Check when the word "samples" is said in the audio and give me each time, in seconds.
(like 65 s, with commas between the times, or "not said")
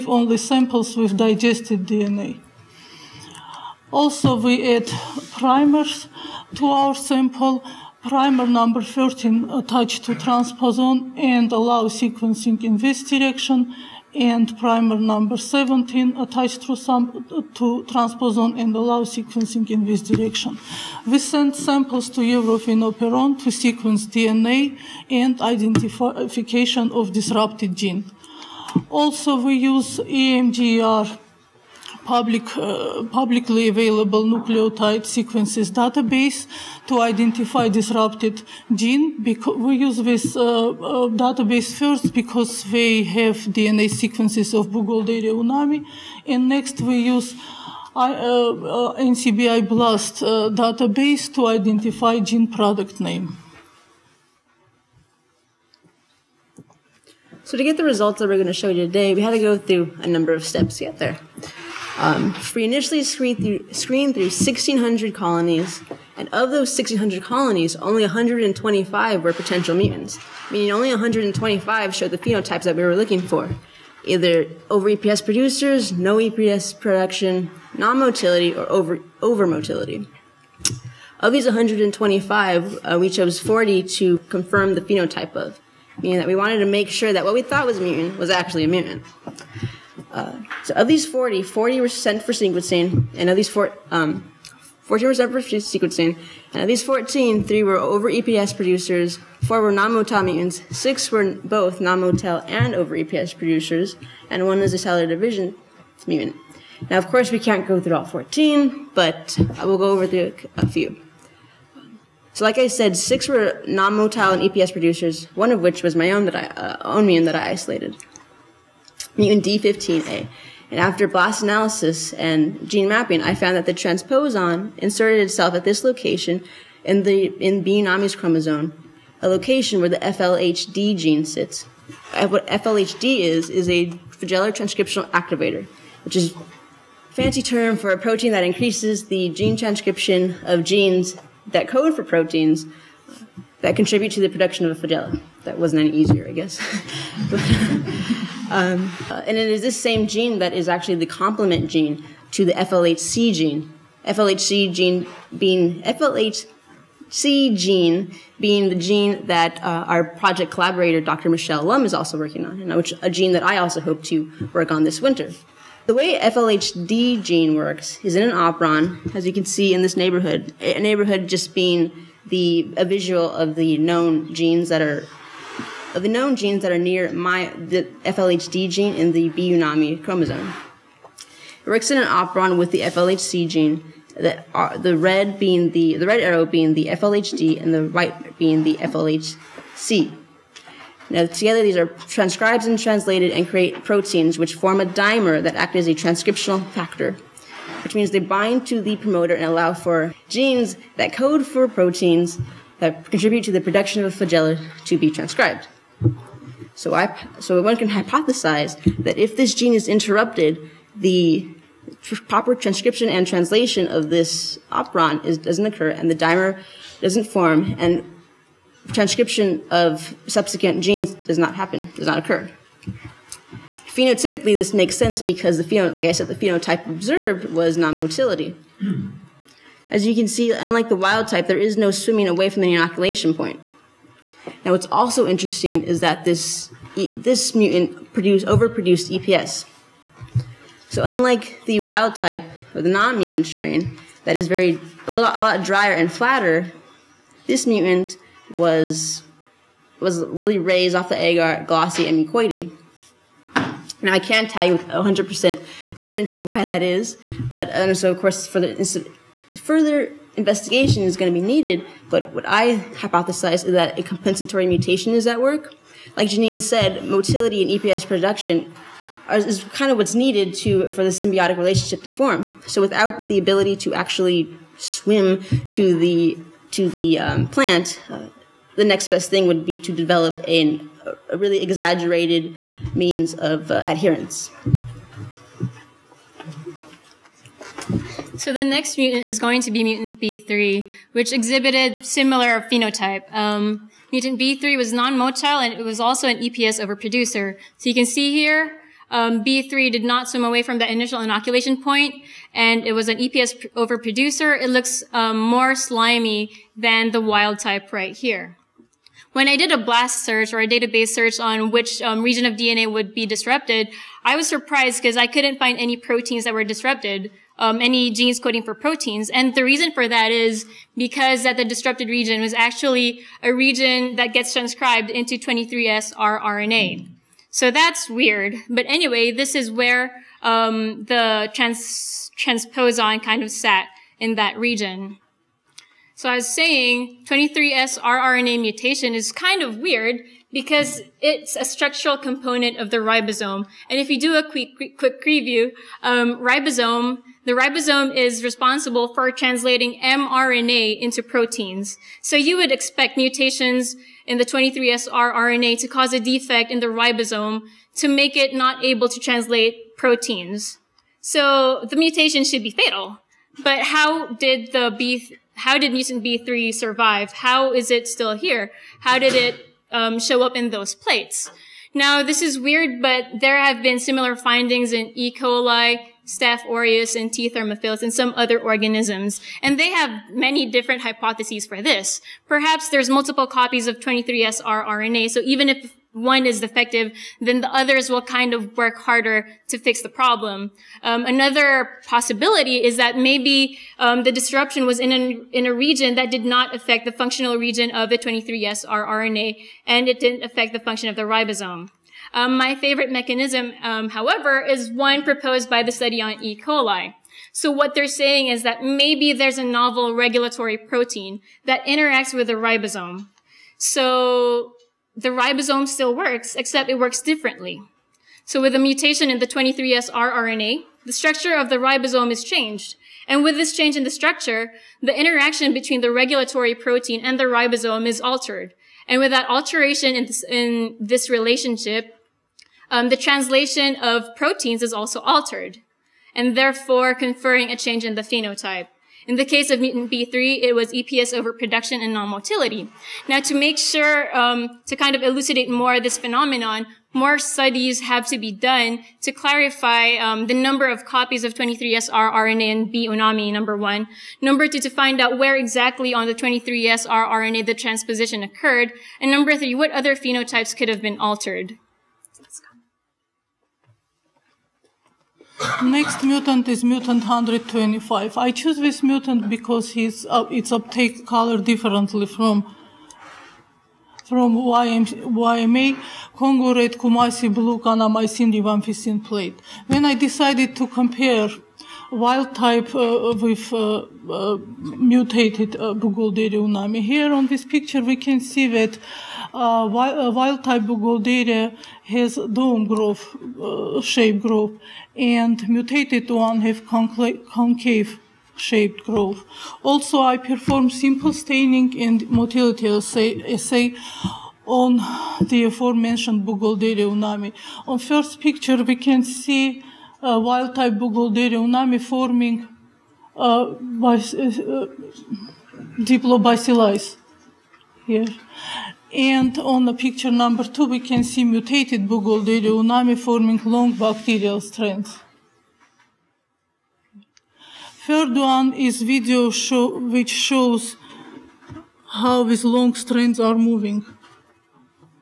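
0 s, 6 s, 21 s.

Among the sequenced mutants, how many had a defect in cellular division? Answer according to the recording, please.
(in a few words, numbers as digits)
1.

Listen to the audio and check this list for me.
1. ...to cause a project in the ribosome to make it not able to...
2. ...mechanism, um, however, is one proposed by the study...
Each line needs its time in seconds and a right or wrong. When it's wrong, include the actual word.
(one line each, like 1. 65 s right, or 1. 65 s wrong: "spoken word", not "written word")
1. 355 s wrong: "defect", not "project"
2. 403 s right.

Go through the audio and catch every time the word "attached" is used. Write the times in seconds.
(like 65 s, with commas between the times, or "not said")
9 s, 16 s.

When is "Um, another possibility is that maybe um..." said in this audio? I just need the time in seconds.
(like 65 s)
391 s.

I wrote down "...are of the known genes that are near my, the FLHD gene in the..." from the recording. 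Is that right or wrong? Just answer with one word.
right.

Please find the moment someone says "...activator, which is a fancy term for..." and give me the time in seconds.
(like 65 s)
135 s.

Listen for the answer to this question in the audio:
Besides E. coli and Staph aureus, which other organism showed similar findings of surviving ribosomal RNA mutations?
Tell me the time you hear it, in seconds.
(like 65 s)
377 s.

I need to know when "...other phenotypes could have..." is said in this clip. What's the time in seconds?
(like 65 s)
459 s.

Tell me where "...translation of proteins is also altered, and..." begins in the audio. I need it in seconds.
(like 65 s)
433 s.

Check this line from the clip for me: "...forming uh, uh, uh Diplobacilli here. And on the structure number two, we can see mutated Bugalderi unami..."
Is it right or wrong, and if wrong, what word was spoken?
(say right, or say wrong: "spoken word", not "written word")
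wrong: "picture", not "structure".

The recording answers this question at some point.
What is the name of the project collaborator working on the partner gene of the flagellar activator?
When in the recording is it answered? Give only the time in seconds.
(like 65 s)
161 s.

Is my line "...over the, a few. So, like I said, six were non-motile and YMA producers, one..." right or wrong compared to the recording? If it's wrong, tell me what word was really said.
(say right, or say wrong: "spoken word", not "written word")
wrong: "EPS", not "YMA".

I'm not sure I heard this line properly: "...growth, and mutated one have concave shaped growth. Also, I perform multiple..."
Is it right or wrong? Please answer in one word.
wrong.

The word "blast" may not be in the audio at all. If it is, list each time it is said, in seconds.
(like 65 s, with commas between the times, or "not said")
49 s, 121 s, 309 s.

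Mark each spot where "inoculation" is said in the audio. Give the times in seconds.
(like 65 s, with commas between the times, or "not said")
232 s, 301 s.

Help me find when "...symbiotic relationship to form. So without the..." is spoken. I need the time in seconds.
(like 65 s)
271 s.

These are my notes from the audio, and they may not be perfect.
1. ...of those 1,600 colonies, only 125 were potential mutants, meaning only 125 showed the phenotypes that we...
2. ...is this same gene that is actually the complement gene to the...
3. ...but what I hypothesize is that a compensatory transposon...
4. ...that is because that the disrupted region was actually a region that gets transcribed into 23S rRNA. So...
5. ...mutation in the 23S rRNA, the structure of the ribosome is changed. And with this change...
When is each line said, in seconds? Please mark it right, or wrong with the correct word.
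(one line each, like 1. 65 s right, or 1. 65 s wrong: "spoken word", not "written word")
1. 66 s right
2. 149 s right
3. 262 s wrong: "mutation", not "transposon"
4. 320 s right
5. 418 s right.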